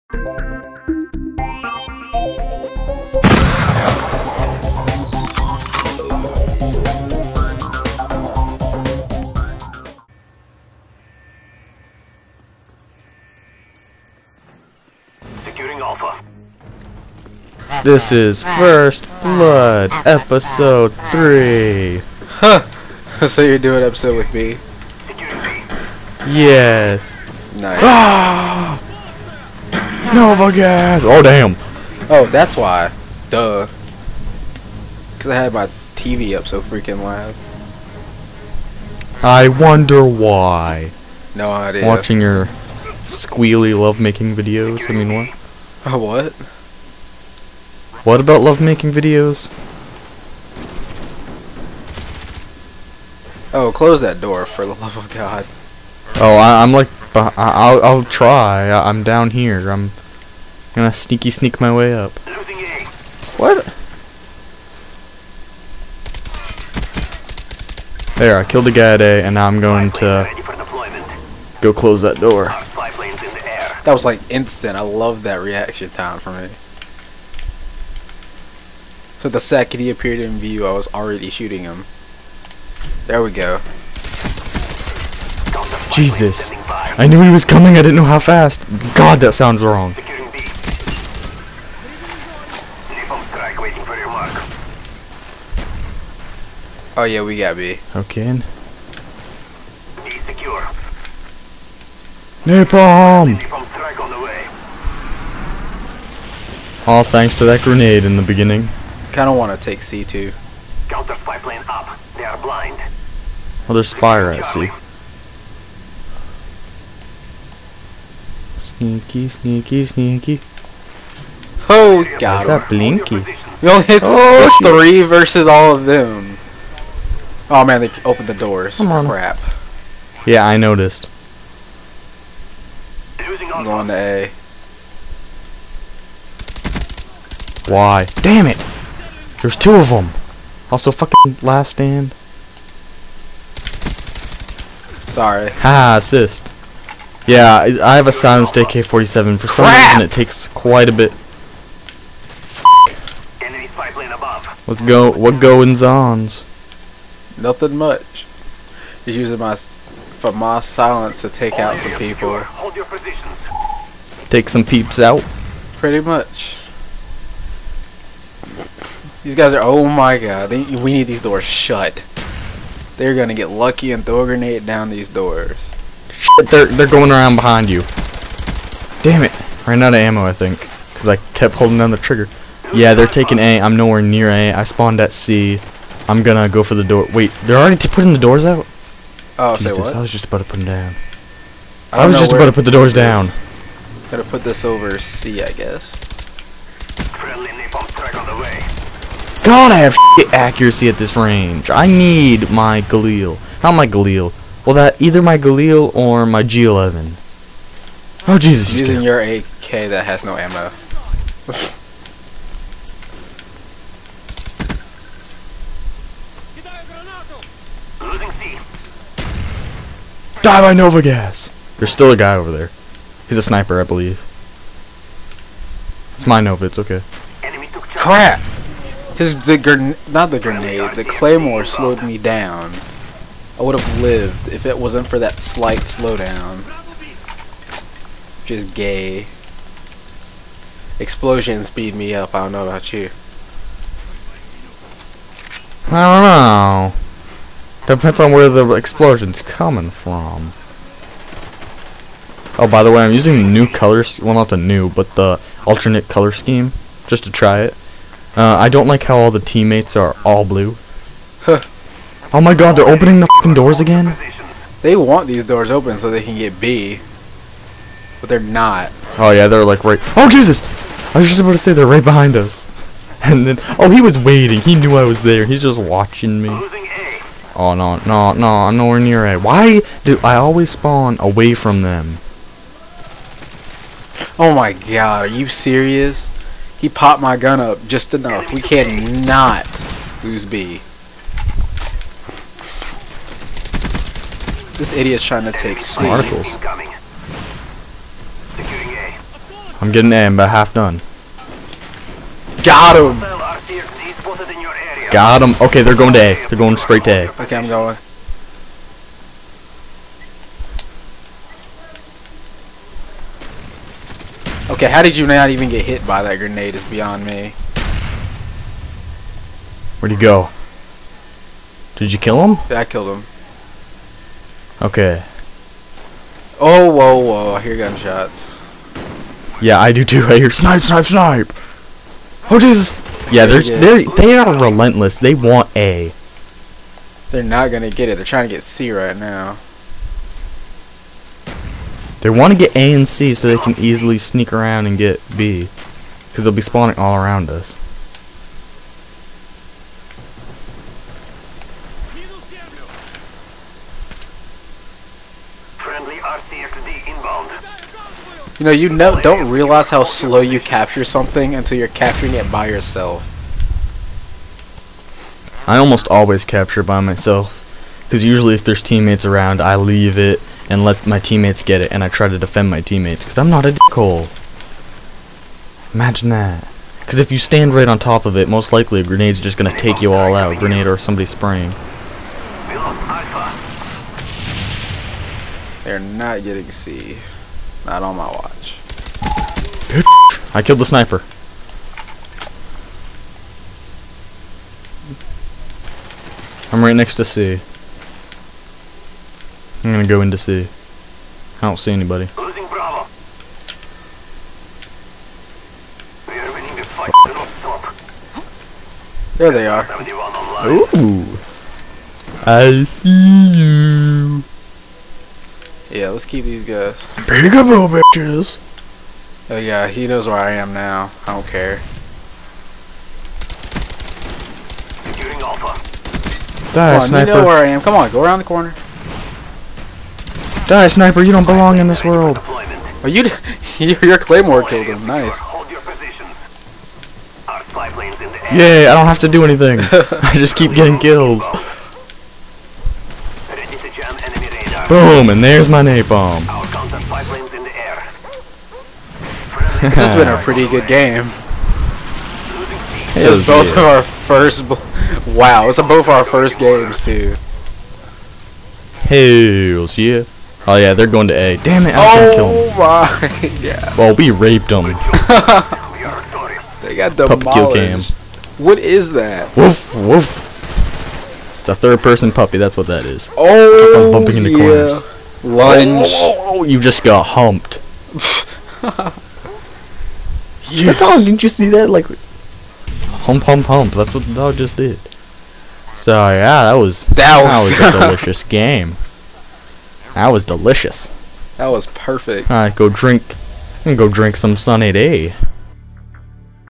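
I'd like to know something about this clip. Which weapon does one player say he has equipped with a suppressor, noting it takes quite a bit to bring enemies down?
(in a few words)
AK-47.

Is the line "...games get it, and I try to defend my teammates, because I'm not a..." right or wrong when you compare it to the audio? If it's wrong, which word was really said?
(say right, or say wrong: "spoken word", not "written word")
wrong: "teammates", not "games".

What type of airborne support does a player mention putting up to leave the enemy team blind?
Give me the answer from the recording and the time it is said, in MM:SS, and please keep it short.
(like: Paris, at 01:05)
Counter spy plane, at 01:50.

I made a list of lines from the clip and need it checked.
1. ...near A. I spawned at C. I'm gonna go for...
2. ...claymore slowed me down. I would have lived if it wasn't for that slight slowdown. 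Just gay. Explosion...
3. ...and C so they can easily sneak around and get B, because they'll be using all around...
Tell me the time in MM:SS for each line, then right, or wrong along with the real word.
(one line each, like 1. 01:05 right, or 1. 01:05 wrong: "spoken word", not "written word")
1. 03:04 right
2. 03:51 right
3. 05:42 wrong: "spawning", not "using".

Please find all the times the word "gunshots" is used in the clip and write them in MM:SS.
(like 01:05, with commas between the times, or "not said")
05:27.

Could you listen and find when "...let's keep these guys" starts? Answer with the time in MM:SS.
06:56.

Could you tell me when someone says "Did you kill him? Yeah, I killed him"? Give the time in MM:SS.
05:21.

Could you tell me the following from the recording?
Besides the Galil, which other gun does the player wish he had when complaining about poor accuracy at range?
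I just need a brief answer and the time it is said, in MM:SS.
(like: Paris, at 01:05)
G11, at 03:26.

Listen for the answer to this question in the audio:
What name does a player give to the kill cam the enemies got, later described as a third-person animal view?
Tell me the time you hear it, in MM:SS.
07:47.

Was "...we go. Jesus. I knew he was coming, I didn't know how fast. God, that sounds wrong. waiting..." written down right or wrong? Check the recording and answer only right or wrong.
right.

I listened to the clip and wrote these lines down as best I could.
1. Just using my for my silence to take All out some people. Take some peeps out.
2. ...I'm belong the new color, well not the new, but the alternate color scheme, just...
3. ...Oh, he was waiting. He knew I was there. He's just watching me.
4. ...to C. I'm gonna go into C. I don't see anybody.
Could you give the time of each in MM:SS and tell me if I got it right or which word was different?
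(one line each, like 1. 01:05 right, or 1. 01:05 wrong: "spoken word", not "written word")
1. 02:39 right
2. 04:13 wrong: "using", not "belong"
3. 04:33 right
4. 06:37 right.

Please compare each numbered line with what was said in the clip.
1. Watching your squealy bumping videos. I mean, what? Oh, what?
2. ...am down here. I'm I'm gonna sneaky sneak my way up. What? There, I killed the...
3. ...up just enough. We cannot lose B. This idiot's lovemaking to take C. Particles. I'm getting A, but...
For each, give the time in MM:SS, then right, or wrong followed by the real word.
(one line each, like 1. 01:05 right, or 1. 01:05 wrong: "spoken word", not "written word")
1. 00:41 wrong: "lovemaking", not "bumping"
2. 00:58 right
3. 04:47 wrong: "trying", not "lovemaking".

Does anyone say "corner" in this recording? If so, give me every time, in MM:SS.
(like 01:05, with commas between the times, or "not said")
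07:08, 07:54.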